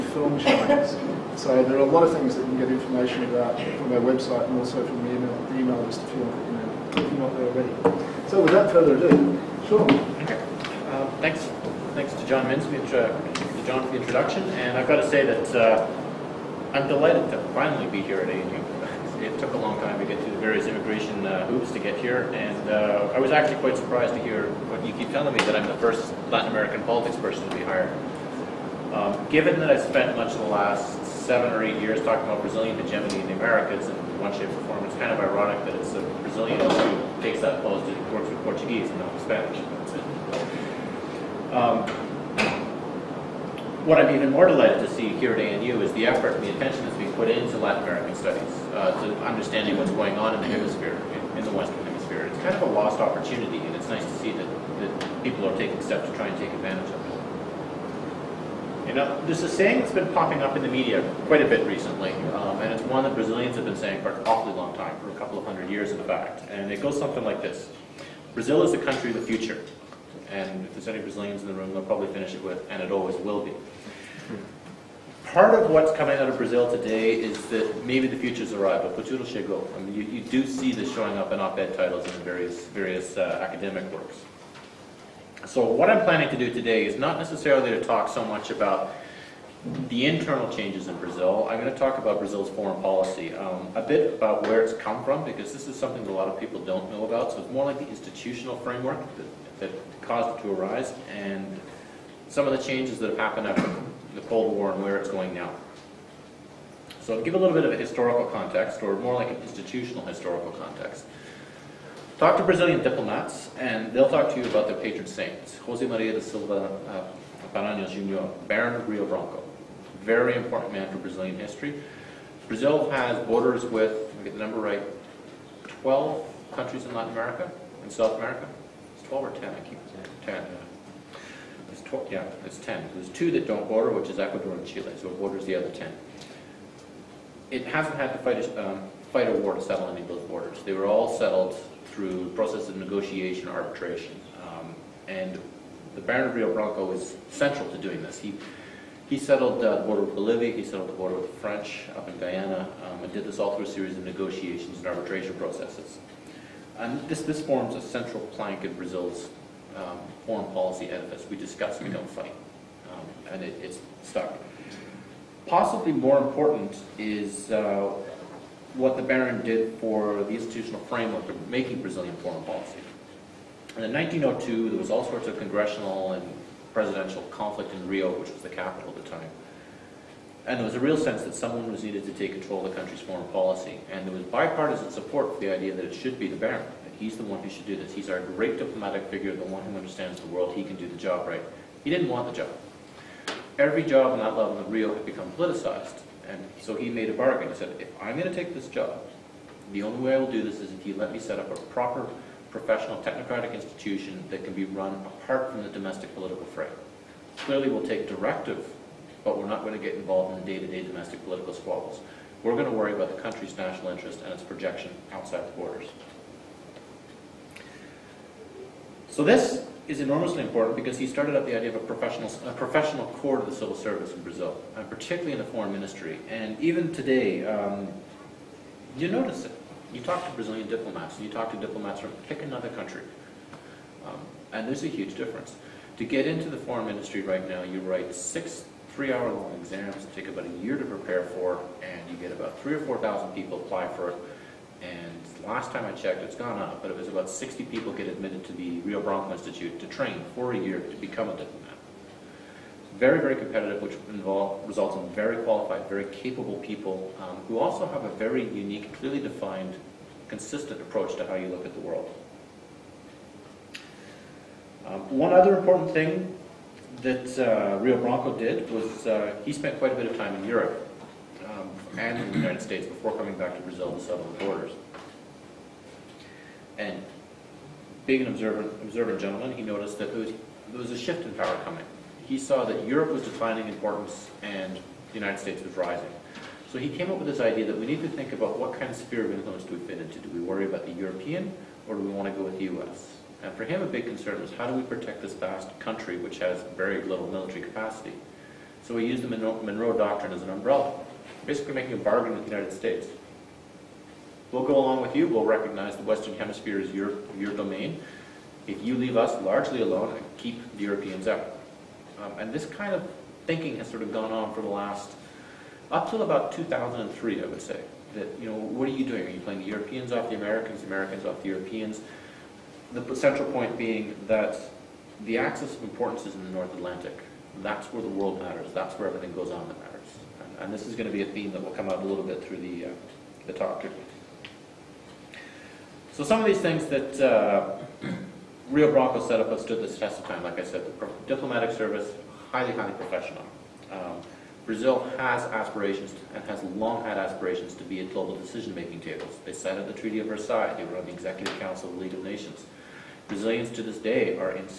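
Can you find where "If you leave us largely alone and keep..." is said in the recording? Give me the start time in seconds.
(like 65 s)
308 s.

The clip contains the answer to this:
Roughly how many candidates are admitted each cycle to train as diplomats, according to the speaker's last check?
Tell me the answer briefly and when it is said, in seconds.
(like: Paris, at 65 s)
60, at 247 s.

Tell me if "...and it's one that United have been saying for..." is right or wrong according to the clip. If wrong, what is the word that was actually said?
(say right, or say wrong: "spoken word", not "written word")
wrong: "Brazilians", not "United".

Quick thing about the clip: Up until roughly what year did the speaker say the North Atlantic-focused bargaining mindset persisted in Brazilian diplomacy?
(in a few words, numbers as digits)
2003.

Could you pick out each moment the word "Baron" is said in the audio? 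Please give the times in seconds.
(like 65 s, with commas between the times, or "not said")
118 s, 146 s, 169 s, 186 s.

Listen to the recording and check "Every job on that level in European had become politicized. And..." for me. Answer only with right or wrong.
wrong.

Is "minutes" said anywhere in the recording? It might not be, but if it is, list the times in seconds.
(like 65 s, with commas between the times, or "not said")
not said.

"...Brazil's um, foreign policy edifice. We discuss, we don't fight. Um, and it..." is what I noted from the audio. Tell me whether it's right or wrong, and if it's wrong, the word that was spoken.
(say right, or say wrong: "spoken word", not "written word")
right.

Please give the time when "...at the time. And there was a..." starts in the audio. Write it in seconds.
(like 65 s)
178 s.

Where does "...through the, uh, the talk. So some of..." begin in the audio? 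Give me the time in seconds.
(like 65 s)
332 s.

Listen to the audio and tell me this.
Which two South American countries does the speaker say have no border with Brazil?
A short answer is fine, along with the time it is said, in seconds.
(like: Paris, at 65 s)
Ecuador and Chile, at 134 s.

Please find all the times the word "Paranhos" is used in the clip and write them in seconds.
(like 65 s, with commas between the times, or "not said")
117 s.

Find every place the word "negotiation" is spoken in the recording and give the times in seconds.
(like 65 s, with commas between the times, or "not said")
142 s, 154 s.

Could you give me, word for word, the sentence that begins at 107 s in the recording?
So I'll give a little bit of a historical context, or more like an institutional historical context.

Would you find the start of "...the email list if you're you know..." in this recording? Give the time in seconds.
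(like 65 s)
5 s.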